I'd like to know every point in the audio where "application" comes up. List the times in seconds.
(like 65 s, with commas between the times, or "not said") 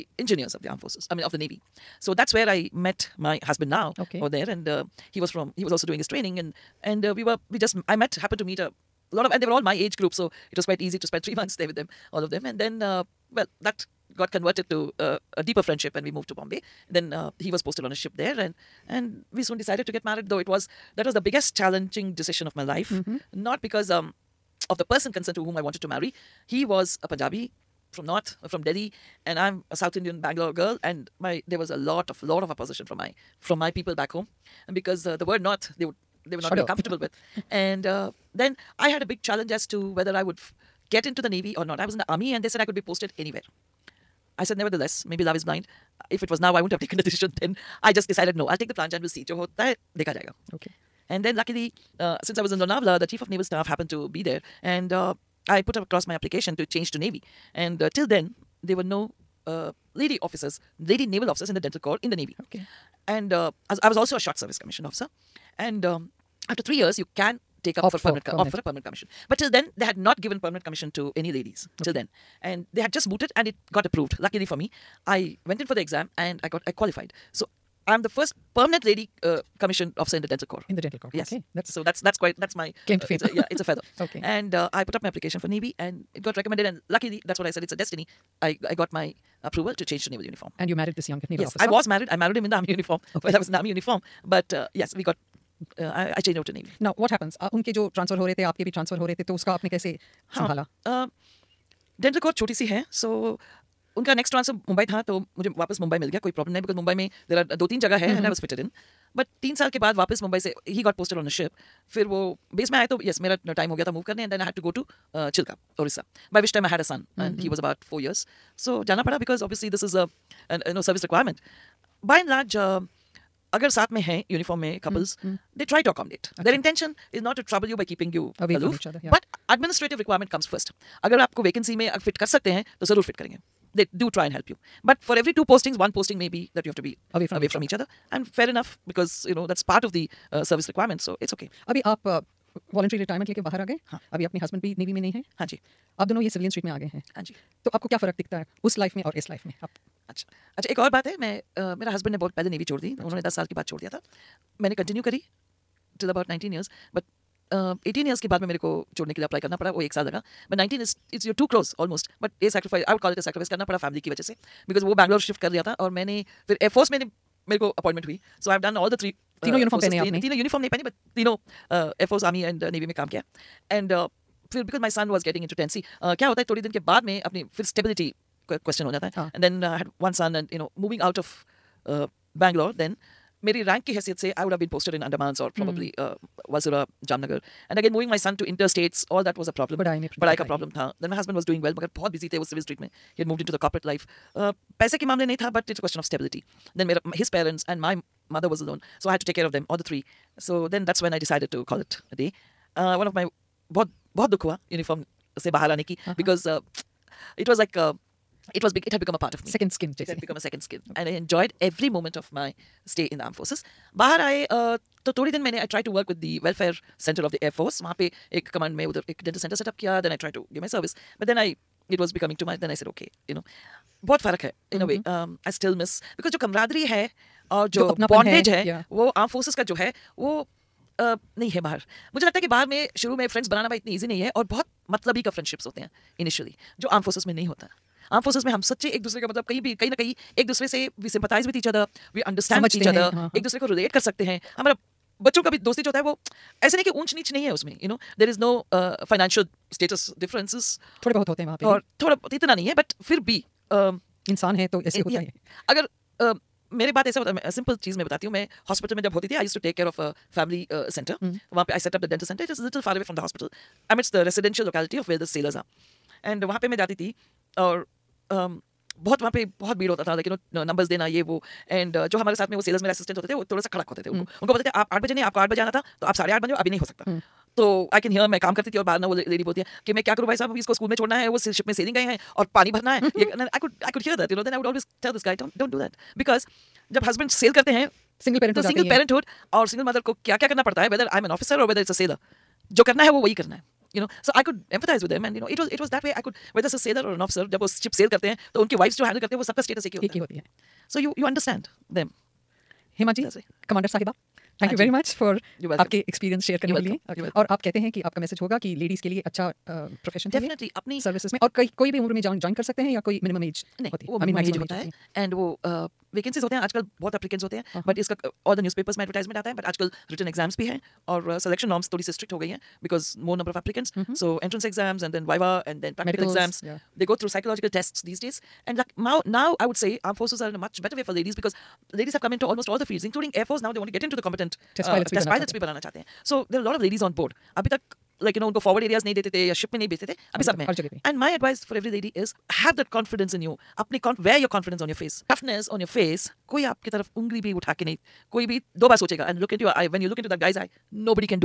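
56 s, 85 s.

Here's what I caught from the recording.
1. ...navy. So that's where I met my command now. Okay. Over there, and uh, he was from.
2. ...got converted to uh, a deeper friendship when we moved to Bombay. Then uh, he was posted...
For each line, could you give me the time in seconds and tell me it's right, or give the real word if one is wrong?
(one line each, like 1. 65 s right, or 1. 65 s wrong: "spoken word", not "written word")
1. 1 s wrong: "husband", not "command"
2. 14 s right.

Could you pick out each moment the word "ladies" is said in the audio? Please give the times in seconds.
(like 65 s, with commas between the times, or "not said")
71 s, 331 s, 336 s.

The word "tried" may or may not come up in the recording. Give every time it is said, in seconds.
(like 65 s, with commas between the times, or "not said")
215 s, 220 s.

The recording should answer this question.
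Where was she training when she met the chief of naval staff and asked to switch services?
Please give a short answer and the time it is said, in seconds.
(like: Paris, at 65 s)
Lonavla, at 52 s.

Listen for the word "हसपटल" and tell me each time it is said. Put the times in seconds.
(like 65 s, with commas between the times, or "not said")
258 s, 263 s.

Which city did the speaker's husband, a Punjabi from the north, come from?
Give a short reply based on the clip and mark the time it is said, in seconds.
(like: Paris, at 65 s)
Delhi, at 28 s.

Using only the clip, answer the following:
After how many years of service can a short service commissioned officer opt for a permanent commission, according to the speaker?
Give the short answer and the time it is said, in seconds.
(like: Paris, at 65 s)
3, at 66 s.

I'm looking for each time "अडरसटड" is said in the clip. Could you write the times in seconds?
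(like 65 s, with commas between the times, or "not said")
242 s, 301 s.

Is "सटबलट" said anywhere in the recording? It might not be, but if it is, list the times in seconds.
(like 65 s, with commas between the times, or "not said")
177 s, 196 s.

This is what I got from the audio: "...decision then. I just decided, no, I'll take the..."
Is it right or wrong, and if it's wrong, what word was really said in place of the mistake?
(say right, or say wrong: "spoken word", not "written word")
right.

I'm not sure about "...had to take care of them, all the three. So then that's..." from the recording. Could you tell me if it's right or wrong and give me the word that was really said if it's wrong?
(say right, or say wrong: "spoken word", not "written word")
right.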